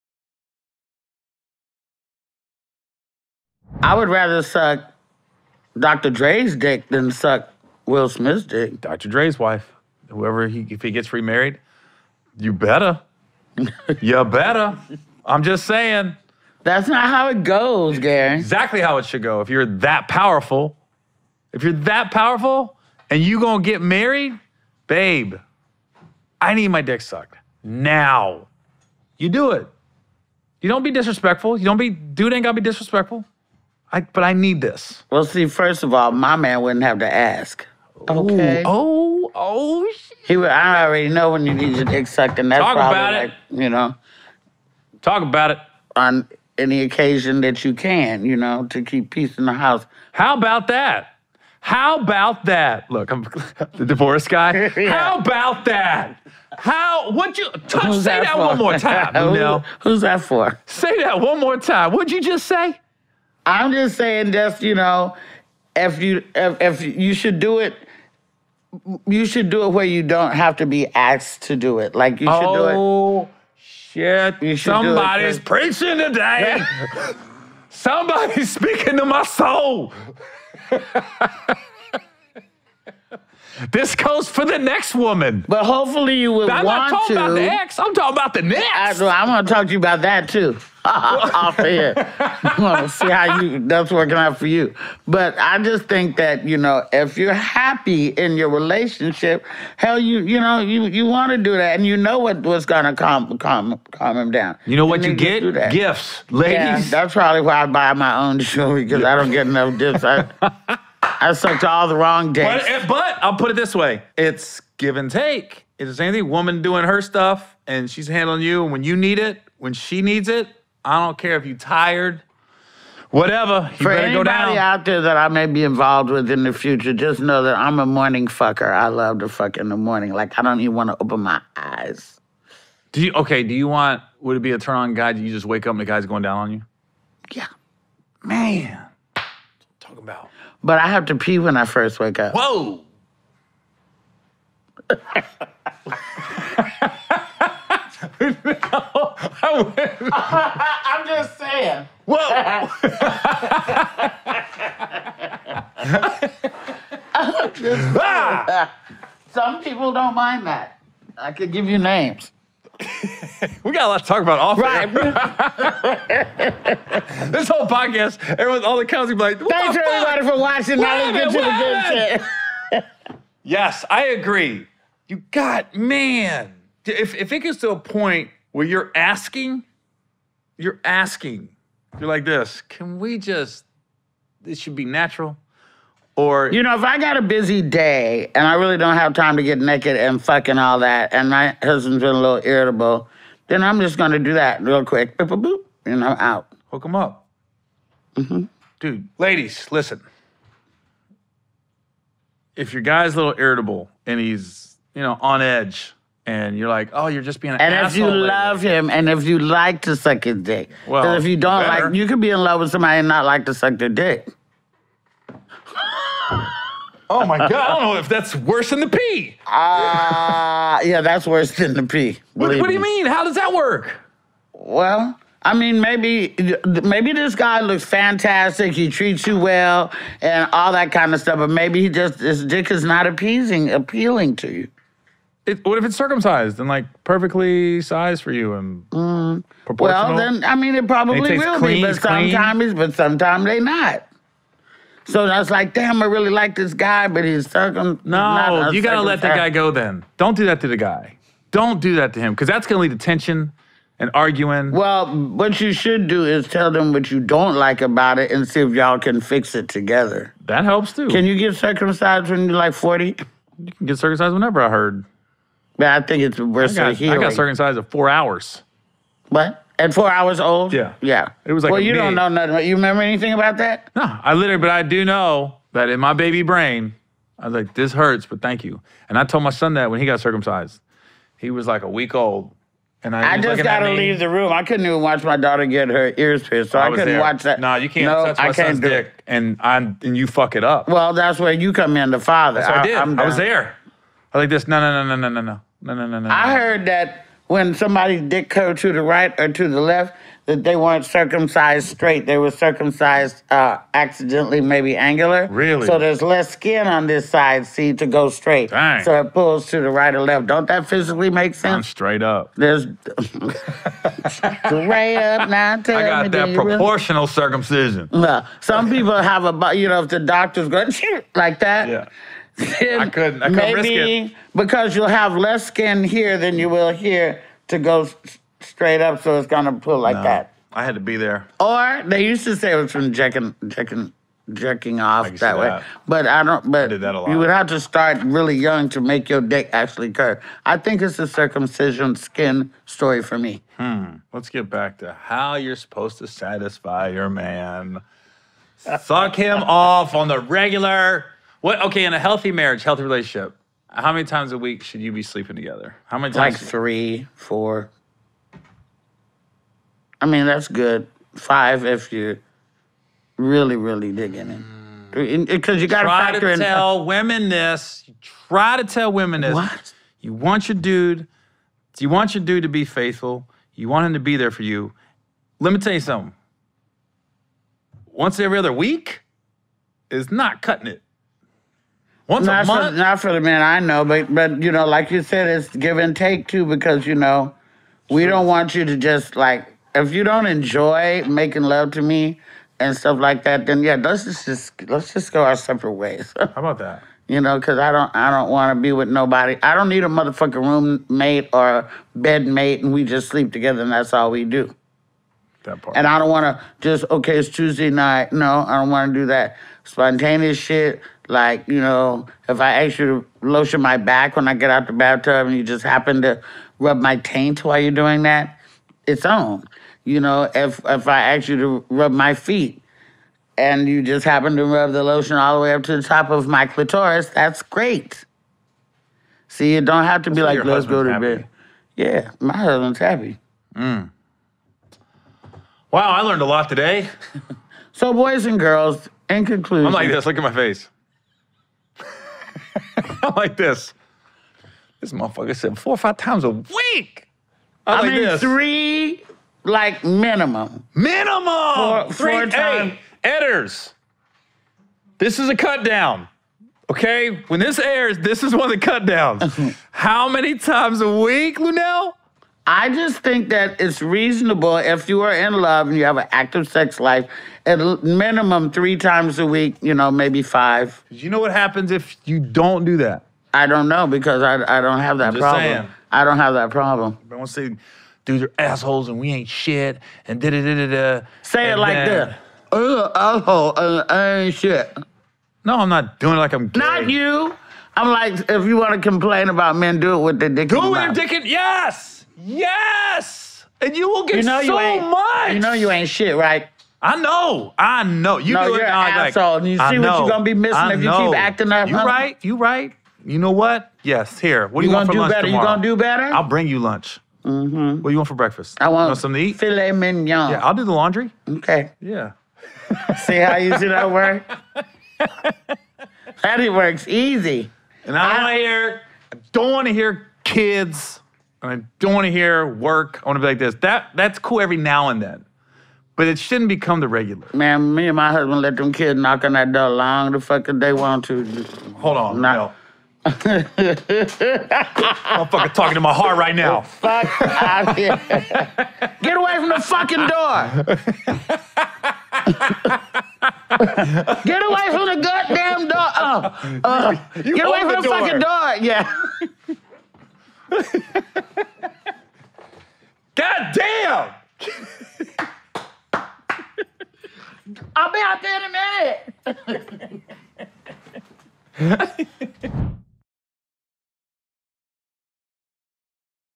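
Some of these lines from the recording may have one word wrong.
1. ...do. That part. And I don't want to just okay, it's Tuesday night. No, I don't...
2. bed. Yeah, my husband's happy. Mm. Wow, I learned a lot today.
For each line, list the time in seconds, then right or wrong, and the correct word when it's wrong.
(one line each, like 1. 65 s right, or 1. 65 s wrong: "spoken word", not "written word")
1. 404 s right
2. 431 s right.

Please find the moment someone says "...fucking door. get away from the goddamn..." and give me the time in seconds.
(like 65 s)
539 s.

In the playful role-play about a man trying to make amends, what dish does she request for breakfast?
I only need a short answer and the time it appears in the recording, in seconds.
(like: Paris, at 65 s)
Filet mignon, at 509 s.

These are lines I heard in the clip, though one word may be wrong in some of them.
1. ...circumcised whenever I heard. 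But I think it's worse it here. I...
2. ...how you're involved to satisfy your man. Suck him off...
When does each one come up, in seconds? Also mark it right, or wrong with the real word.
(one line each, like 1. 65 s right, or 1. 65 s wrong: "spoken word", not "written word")
1. 263 s right
2. 345 s wrong: "supposed", not "involved".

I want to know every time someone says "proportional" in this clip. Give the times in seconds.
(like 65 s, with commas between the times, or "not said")
239 s, 316 s.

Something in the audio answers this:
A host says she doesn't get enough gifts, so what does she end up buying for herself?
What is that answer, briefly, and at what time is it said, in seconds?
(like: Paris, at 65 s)
Jewelry, at 108 s.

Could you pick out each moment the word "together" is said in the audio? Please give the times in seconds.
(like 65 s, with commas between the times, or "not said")
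259 s, 355 s, 403 s.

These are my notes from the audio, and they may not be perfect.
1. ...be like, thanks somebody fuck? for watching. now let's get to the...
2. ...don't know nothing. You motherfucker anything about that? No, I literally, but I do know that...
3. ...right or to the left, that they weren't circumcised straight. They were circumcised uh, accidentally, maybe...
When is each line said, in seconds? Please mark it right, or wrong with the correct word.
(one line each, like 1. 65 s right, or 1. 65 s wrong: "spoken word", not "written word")
1. 169 s wrong: "everybody", not "somebody"
2. 271 s wrong: "remember", not "motherfucker"
3. 299 s right.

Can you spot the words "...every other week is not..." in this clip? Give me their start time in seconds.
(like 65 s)
378 s.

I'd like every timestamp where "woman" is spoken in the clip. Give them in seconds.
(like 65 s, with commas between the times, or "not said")
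84 s, 116 s.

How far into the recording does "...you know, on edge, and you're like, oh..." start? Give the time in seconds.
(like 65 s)
204 s.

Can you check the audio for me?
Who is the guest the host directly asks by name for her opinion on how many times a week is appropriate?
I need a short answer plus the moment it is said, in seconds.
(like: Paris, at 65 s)
Luenell, at 461 s.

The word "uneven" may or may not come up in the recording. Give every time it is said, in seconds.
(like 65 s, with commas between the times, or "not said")
not said.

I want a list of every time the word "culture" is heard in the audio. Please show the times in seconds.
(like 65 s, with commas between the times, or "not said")
not said.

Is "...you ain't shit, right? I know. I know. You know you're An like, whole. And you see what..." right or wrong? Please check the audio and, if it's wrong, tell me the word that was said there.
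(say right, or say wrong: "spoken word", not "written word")
wrong: "asshole", not "whole".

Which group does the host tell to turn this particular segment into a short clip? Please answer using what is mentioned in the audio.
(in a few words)
Editors.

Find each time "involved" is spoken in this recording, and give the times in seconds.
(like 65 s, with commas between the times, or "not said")
125 s.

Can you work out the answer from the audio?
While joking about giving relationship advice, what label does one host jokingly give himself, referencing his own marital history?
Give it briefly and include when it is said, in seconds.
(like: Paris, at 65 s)
the divorce guy, at 53 s.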